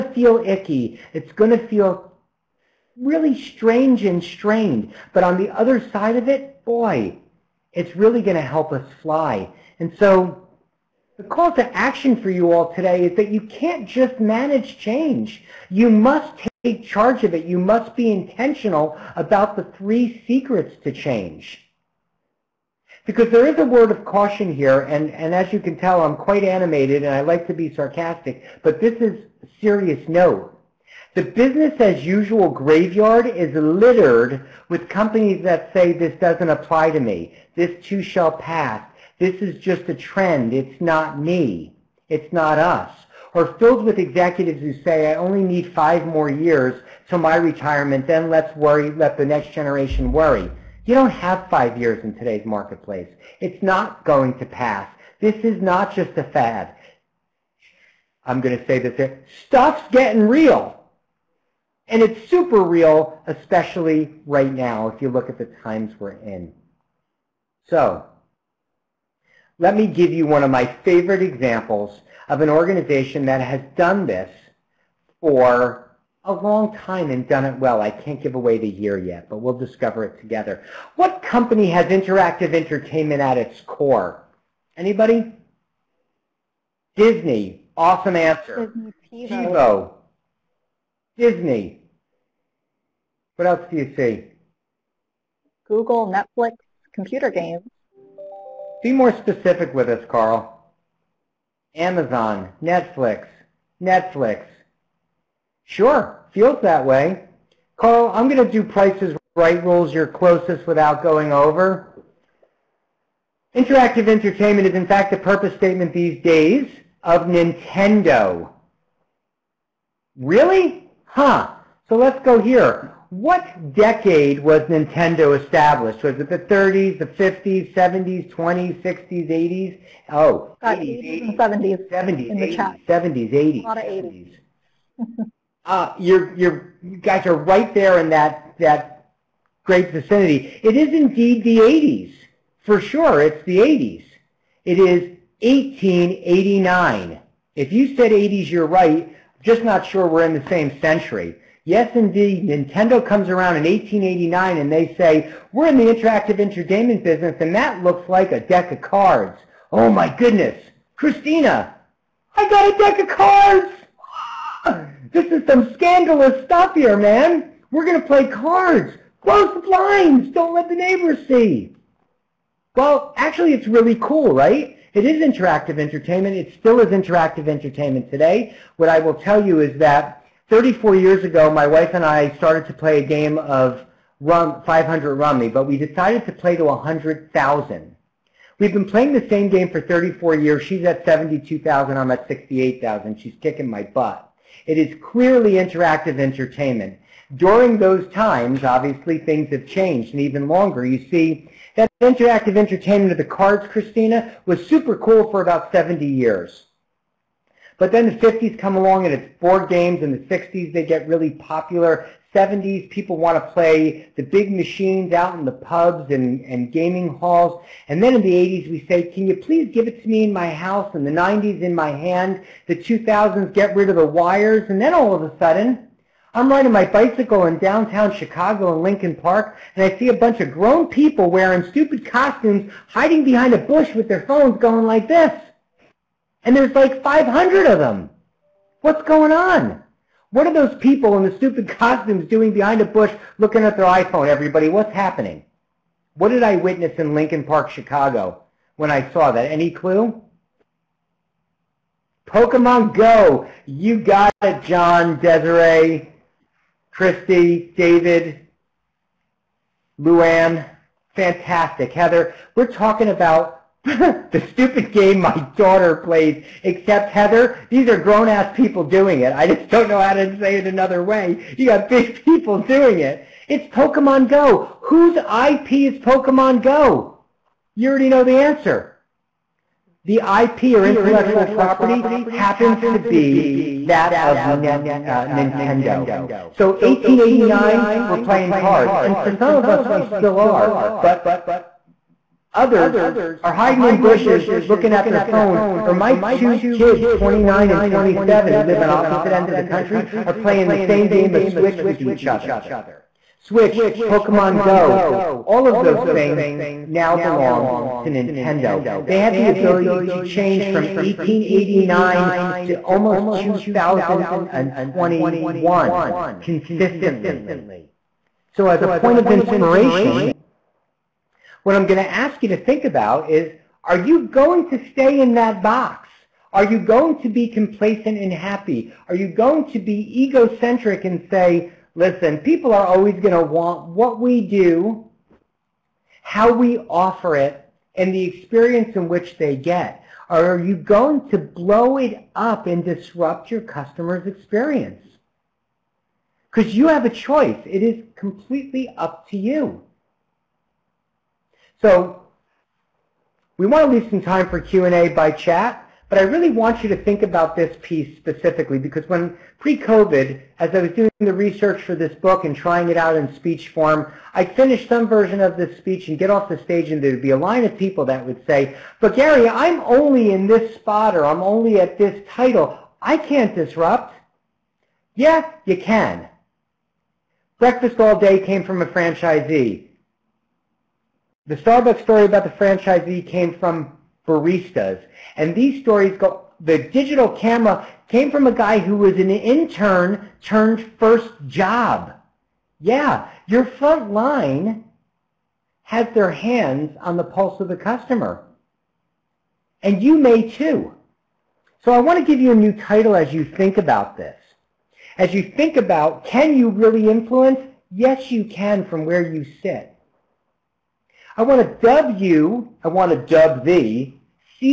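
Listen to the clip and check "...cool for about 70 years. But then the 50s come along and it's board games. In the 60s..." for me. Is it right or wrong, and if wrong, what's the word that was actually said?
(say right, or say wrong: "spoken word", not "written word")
right.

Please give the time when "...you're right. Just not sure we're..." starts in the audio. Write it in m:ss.
2:28.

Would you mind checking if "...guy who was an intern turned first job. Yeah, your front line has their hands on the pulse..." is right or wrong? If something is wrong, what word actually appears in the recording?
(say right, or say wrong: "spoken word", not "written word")
right.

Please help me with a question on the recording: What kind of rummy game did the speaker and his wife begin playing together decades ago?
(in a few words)
500 Rummy.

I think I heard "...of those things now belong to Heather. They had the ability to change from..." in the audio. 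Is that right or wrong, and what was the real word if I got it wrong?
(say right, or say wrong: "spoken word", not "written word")
wrong: "Nintendo", not "Heather".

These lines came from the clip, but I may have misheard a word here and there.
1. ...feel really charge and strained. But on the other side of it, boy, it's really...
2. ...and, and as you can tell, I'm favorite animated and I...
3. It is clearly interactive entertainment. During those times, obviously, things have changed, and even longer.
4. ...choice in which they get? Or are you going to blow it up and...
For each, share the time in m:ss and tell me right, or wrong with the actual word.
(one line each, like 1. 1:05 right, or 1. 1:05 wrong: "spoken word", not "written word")
1. 0:01 wrong: "strange", not "charge"
2. 0:24 wrong: "quite", not "favorite"
3. 3:14 right
4. 5:38 wrong: "experience", not "choice".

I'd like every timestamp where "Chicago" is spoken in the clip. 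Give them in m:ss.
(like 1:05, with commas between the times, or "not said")
3:48, 4:07.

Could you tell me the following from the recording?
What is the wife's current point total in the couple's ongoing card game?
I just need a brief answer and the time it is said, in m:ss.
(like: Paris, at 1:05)
72,000, at 3:11.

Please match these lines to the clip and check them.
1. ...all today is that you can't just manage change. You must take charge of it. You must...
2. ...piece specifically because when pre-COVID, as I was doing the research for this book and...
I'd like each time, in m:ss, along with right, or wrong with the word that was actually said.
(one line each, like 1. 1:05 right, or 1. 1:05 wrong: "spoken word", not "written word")
1. 0:12 right
2. 5:57 right.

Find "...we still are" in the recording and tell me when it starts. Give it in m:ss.
4:49.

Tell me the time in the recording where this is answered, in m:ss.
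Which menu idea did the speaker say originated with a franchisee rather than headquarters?
6:17.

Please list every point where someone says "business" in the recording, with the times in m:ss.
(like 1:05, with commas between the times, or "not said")
0:31, 2:37.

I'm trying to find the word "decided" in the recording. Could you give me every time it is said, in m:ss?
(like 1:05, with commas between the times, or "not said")
3:05.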